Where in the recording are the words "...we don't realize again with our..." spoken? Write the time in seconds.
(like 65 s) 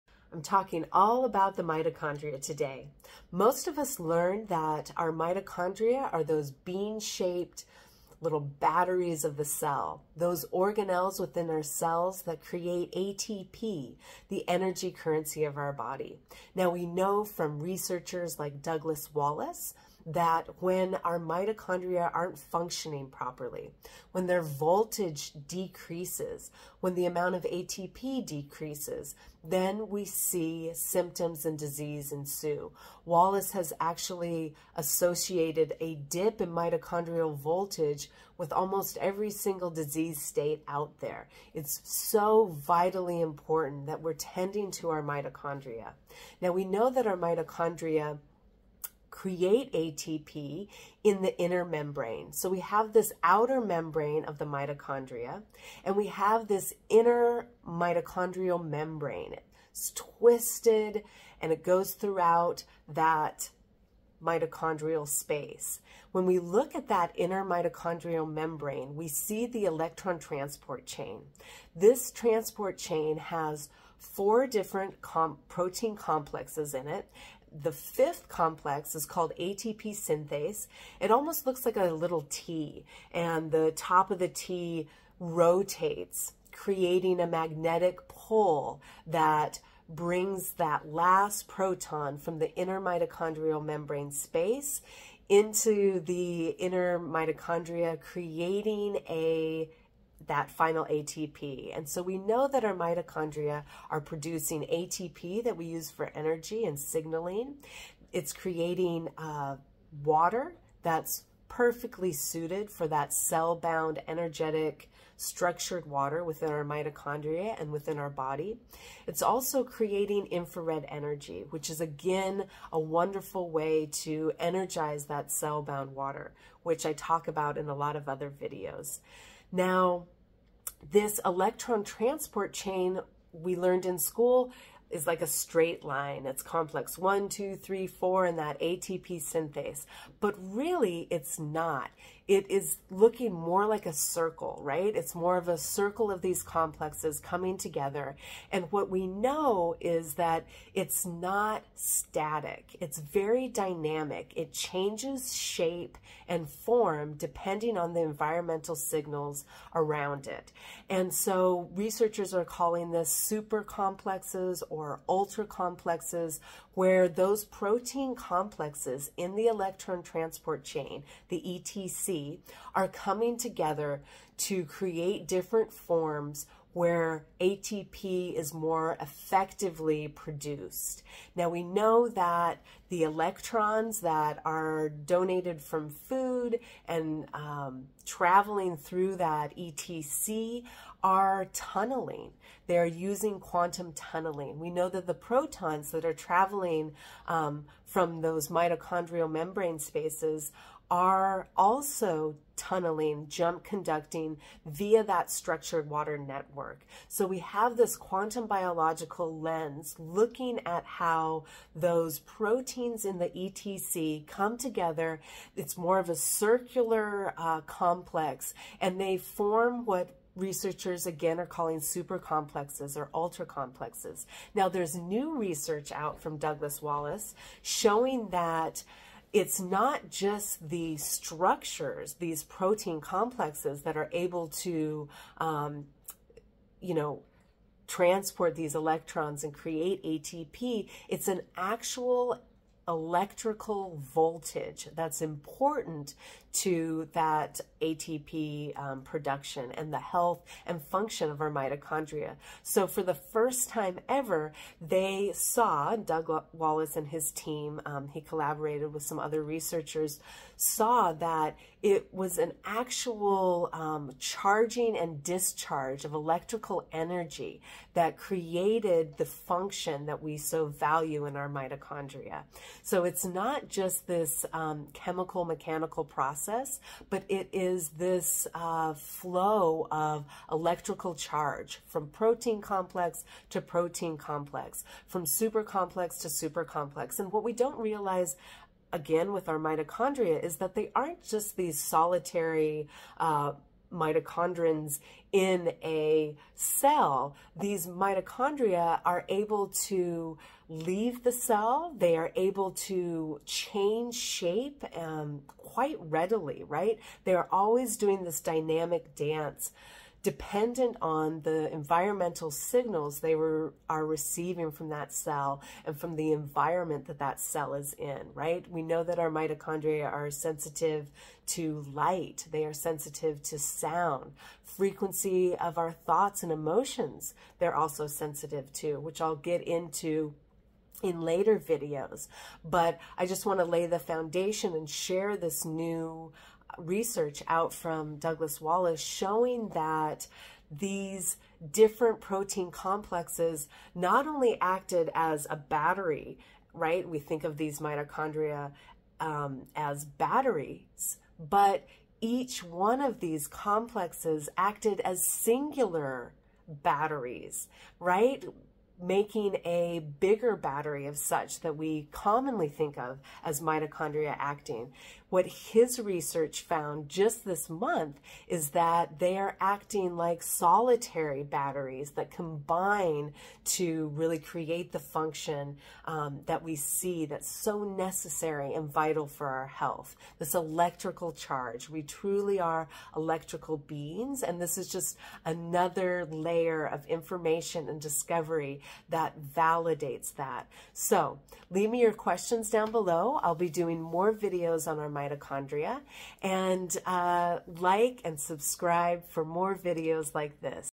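287 s.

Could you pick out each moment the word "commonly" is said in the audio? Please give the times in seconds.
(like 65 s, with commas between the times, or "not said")
362 s.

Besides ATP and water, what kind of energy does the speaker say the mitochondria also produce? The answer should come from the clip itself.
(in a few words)
Infrared energy.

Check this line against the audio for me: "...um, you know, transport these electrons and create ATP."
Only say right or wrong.
right.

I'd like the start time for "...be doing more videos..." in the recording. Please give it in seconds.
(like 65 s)
393 s.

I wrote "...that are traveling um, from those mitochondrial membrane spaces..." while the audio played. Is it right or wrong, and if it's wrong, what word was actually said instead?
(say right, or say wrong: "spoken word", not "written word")
right.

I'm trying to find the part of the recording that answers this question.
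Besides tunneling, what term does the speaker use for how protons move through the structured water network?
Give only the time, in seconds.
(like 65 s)
203 s.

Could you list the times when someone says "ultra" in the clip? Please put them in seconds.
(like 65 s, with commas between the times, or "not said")
165 s, 223 s.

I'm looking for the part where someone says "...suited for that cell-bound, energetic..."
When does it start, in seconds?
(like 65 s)
112 s.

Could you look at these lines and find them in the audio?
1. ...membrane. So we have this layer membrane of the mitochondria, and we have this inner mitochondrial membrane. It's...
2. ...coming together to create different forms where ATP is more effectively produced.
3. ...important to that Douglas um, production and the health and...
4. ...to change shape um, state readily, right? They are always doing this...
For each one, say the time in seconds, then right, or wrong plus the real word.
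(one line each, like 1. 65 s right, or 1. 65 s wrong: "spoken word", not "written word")
1. 51 s wrong: "outer", not "layer"
2. 172 s right
3. 245 s wrong: "ATP", not "Douglas"
4. 302 s wrong: "quite", not "state".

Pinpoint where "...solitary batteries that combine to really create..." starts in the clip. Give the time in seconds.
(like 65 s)
370 s.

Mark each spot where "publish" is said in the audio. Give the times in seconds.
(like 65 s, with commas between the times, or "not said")
not said.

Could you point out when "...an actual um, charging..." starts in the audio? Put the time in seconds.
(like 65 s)
262 s.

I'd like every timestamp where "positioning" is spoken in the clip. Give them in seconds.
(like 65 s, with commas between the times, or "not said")
not said.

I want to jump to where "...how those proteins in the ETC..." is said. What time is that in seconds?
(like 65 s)
210 s.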